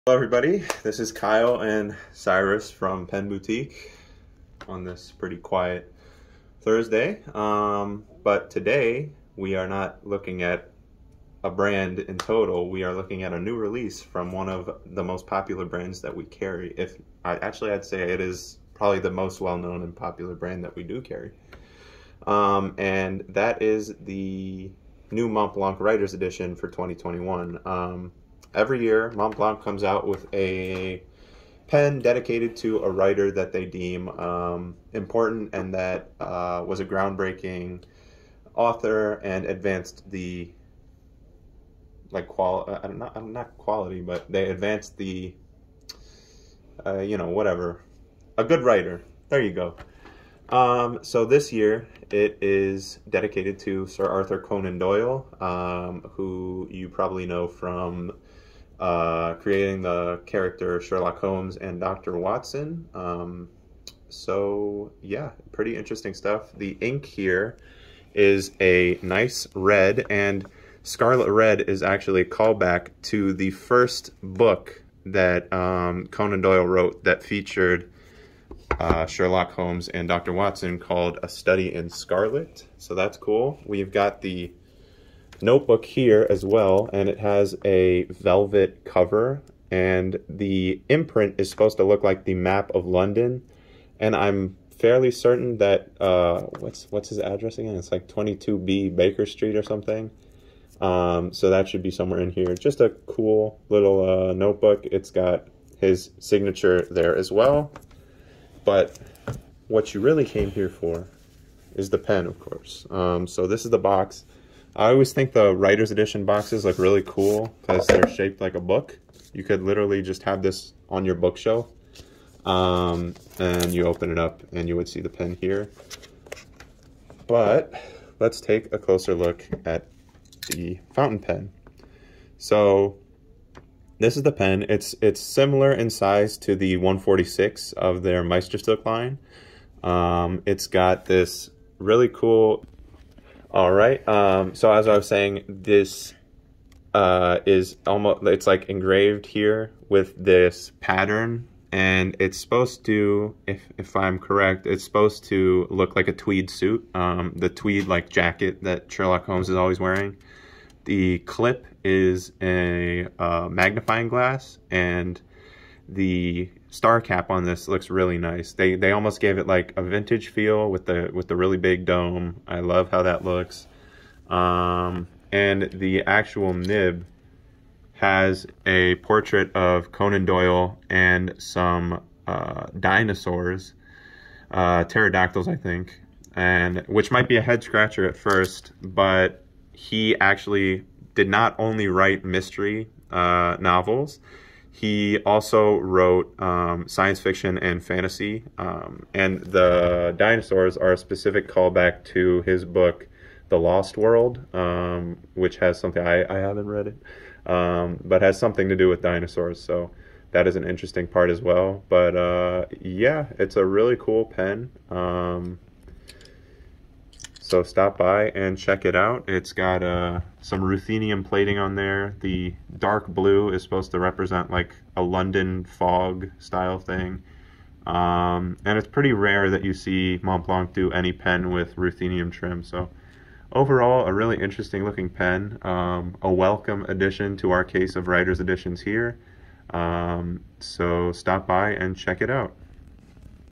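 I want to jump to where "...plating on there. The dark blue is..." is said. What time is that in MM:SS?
03:41.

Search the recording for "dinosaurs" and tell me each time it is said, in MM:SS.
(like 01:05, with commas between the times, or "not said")
03:02, 03:20, 03:29.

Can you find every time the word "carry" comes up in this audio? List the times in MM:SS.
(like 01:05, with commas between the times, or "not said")
00:16, 00:21.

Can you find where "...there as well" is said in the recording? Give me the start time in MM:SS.
01:46.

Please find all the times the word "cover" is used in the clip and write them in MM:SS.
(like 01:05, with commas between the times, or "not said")
01:28.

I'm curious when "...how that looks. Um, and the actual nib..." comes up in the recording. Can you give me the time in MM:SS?
02:52.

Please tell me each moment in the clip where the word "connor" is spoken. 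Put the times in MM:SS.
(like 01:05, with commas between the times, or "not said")
not said.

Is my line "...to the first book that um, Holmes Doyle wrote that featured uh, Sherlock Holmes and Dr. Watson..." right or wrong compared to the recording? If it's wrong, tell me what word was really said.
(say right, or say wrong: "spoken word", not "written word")
wrong: "Conan", not "Holmes".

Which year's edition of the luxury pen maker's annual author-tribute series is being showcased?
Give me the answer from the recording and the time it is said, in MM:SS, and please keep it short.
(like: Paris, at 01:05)
2021, at 00:26.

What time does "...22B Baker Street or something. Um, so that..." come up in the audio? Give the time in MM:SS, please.
01:38.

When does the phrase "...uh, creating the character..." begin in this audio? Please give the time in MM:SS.
00:58.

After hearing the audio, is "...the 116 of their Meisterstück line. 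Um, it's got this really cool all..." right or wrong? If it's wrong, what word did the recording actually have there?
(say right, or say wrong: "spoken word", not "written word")
wrong: "146", not "116".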